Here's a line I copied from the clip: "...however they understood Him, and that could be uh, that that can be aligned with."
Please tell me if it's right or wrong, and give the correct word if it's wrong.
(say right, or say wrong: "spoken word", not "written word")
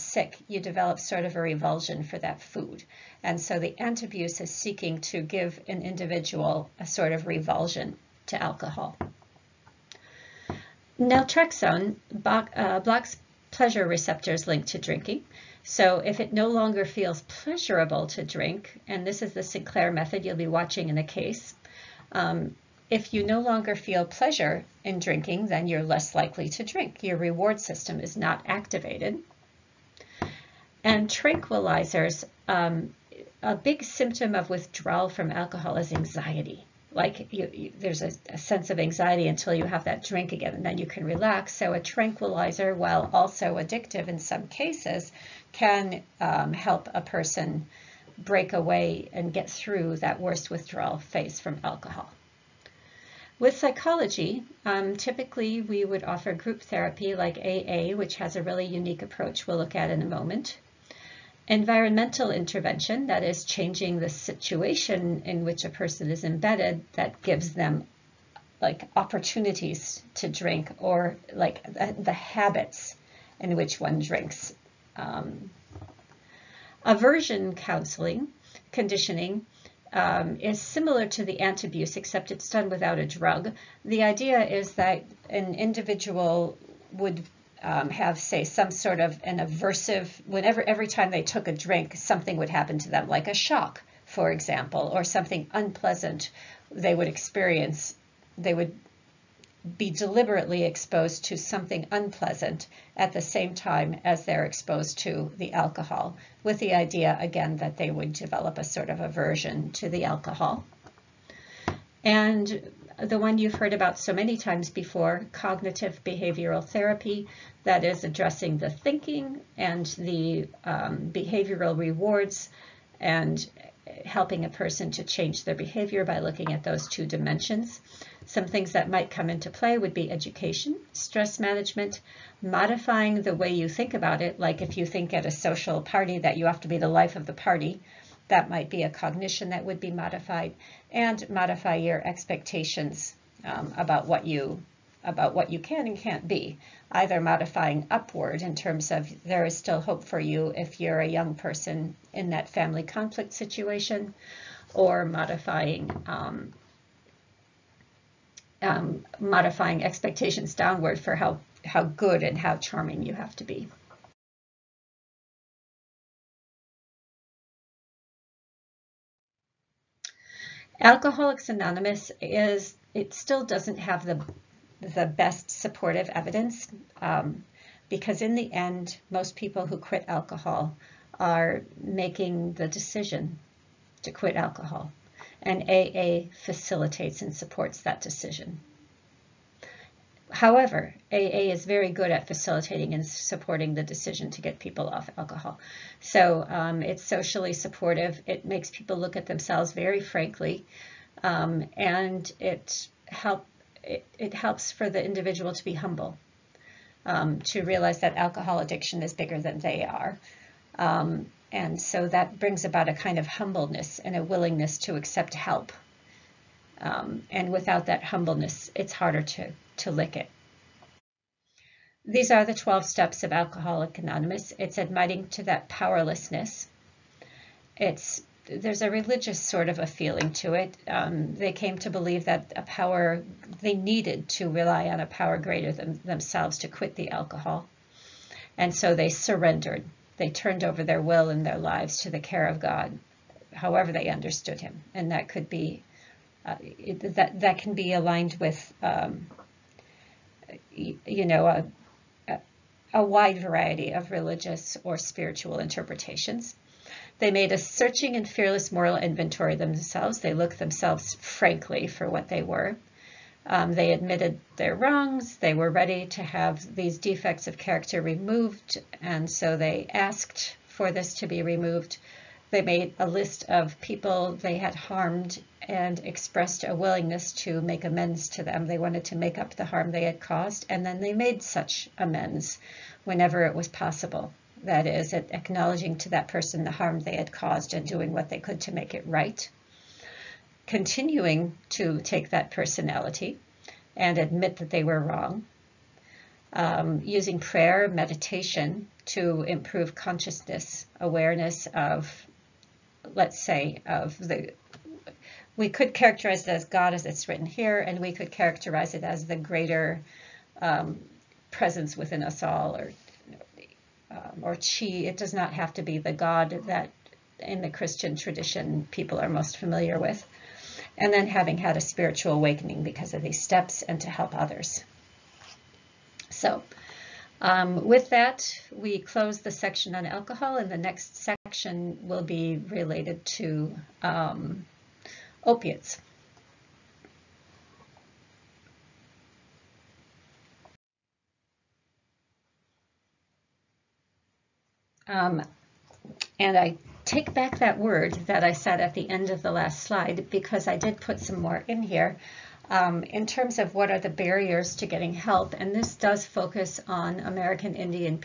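right.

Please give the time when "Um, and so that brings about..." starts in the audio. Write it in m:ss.
3:30.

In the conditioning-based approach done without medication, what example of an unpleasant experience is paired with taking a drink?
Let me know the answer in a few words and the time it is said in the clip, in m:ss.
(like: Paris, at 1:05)
A shock, at 1:33.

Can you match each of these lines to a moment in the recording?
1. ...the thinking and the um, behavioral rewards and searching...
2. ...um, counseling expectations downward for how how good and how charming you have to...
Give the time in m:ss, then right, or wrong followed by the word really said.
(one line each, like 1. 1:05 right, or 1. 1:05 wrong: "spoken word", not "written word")
1. 1:58 wrong: "helping", not "searching"
2. 2:38 wrong: "modifying", not "counseling".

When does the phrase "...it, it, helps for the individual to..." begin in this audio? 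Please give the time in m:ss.
3:23.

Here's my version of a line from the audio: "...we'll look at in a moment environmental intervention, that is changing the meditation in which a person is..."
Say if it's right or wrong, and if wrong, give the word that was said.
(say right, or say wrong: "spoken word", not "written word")
wrong: "situation", not "meditation".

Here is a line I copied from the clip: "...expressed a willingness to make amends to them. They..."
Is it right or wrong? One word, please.
right.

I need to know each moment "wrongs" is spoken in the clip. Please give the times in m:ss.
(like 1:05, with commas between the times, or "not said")
4:24, 4:54.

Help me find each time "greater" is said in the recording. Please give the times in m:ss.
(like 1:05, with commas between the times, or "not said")
3:55, 5:09.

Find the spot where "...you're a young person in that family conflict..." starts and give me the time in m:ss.
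2:30.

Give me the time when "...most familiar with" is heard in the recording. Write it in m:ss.
5:19.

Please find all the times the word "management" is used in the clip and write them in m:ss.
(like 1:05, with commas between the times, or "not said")
2:11.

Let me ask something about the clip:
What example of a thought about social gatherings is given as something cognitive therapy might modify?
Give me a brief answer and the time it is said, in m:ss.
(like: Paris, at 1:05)
Be the life of the party, at 2:16.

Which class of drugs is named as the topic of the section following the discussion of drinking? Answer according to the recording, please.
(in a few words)
Opiates.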